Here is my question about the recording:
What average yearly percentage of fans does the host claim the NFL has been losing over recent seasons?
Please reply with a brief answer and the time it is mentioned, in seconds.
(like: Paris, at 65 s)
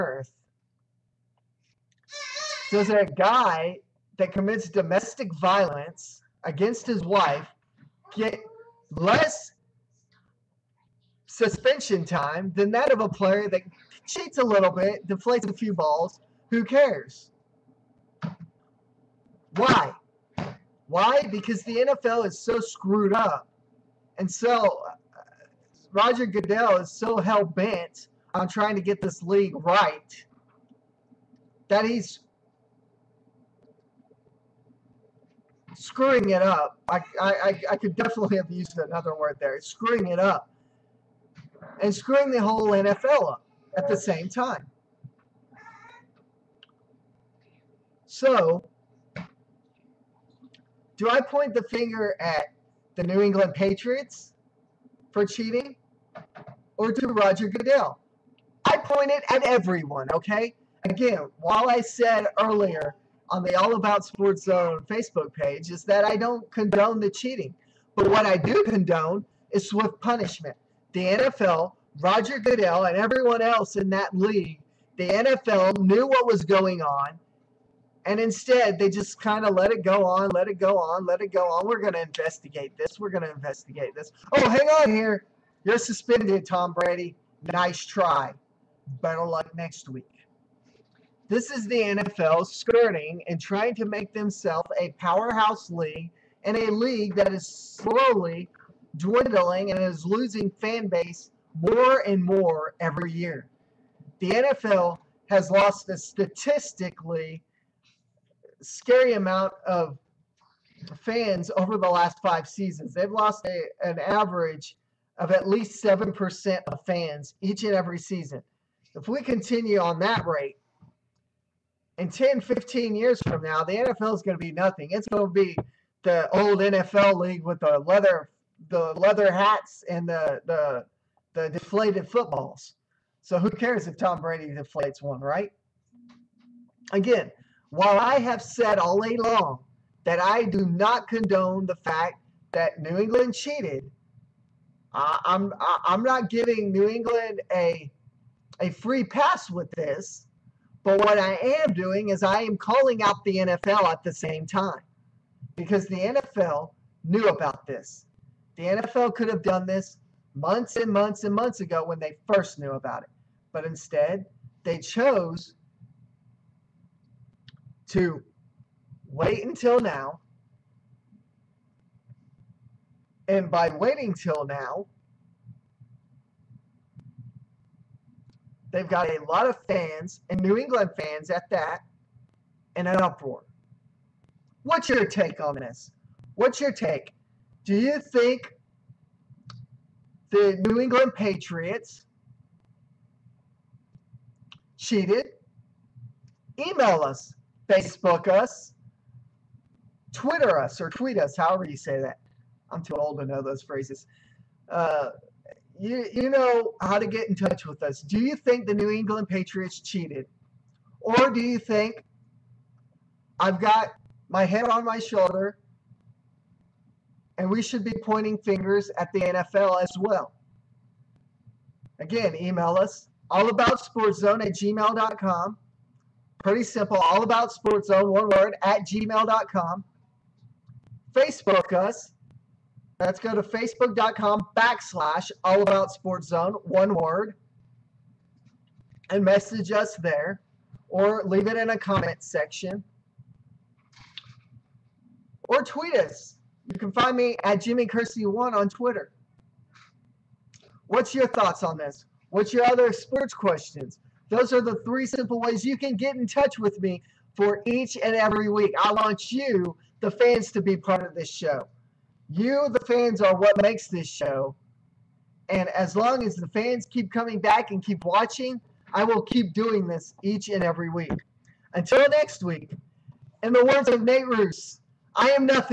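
7%, at 115 s.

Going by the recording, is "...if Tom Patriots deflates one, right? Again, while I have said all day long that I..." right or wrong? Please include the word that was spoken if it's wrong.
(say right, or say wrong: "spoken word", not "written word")
wrong: "Brady", not "Patriots".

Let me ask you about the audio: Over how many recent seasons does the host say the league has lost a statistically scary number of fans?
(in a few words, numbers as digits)
5.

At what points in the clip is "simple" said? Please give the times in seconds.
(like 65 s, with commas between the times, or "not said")
226 s, 255 s.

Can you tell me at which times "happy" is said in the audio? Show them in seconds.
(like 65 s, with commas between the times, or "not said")
not said.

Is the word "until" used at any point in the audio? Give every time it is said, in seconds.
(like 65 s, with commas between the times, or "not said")
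169 s, 271 s.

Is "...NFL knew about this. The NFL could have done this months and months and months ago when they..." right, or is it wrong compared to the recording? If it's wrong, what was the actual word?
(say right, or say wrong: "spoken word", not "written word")
right.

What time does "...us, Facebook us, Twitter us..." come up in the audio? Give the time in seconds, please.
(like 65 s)
197 s.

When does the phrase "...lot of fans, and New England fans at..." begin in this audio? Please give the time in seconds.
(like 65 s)
179 s.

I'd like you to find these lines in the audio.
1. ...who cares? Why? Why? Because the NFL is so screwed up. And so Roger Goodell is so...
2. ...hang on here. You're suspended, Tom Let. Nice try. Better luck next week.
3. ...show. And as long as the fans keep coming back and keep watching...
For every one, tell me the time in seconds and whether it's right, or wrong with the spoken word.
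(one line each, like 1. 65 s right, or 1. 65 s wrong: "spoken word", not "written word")
1. 16 s right
2. 84 s wrong: "Brady", not "Let"
3. 264 s right.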